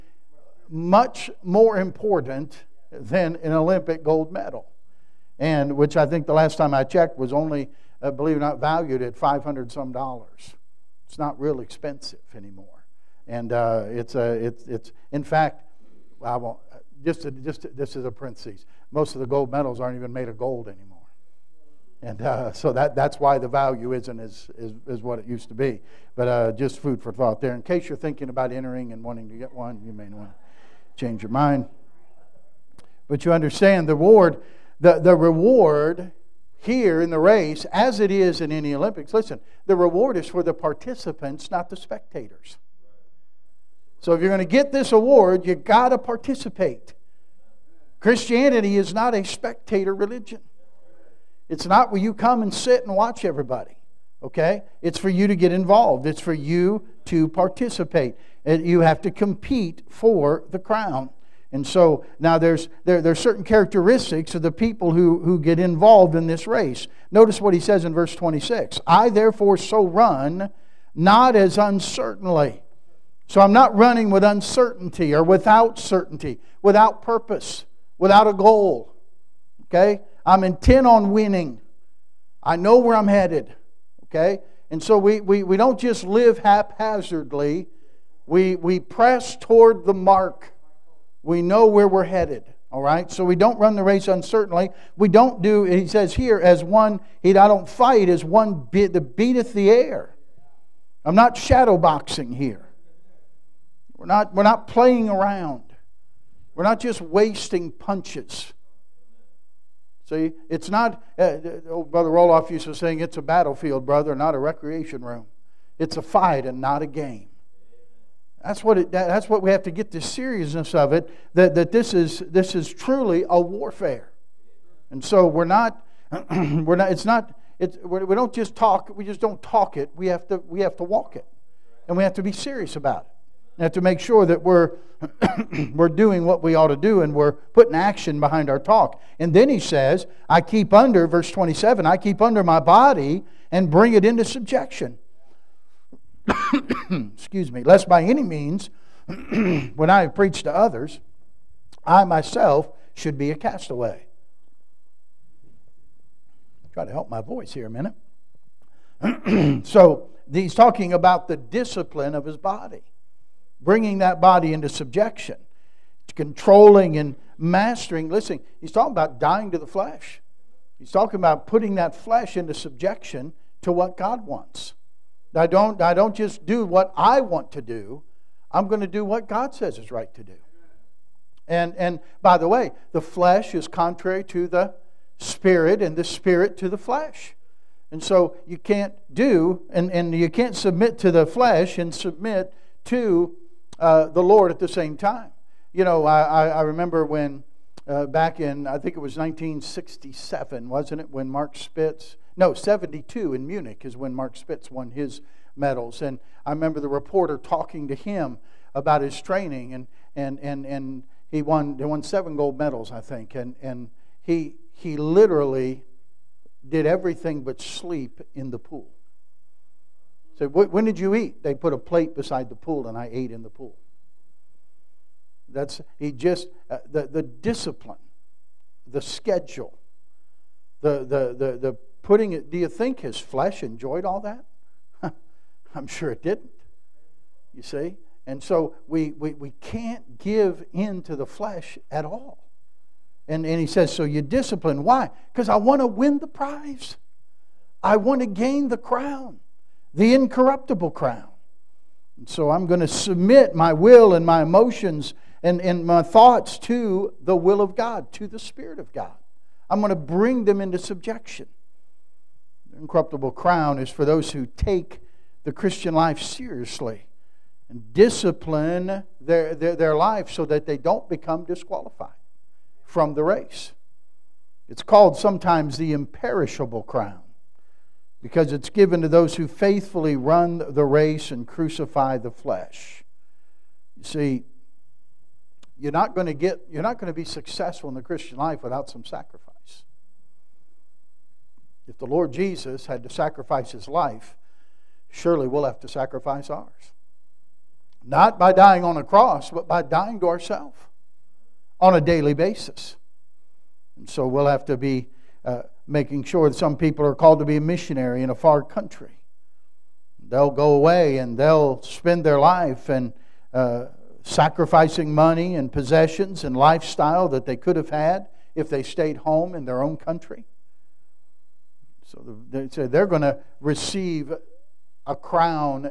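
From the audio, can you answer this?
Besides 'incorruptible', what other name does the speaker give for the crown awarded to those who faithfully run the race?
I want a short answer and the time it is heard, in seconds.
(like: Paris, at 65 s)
imperishable crown, at 275 s.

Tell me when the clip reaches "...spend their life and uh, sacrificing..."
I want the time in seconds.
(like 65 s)
311 s.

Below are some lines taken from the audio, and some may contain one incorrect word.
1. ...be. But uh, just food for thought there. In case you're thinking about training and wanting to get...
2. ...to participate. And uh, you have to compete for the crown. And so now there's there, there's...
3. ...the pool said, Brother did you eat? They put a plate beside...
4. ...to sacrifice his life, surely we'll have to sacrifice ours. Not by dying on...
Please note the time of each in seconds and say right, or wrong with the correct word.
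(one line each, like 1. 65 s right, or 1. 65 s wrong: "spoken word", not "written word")
1. 25 s wrong: "entering", not "training"
2. 57 s right
3. 218 s wrong: "When", not "Brother"
4. 293 s right.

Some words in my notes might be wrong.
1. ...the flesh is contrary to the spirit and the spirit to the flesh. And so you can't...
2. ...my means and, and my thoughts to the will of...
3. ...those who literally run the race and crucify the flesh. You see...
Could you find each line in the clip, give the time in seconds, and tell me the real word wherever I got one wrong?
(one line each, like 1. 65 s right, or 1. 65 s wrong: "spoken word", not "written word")
1. 182 s right
2. 254 s wrong: "emotions", not "means"
3. 279 s wrong: "faithfully", not "literally".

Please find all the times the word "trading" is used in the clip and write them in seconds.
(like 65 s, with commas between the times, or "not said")
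not said.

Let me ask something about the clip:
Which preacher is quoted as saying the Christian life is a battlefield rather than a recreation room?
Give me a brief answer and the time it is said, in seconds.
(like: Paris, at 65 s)
Brother Roloff, at 111 s.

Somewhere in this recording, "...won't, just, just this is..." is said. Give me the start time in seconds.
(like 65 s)
16 s.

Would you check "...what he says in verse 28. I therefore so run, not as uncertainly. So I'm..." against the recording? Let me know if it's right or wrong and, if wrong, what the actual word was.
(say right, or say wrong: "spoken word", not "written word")
wrong: "26", not "28".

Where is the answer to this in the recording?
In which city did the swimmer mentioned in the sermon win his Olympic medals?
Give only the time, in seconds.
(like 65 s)
203 s.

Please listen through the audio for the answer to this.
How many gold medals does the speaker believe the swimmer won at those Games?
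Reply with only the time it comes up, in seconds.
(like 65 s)
212 s.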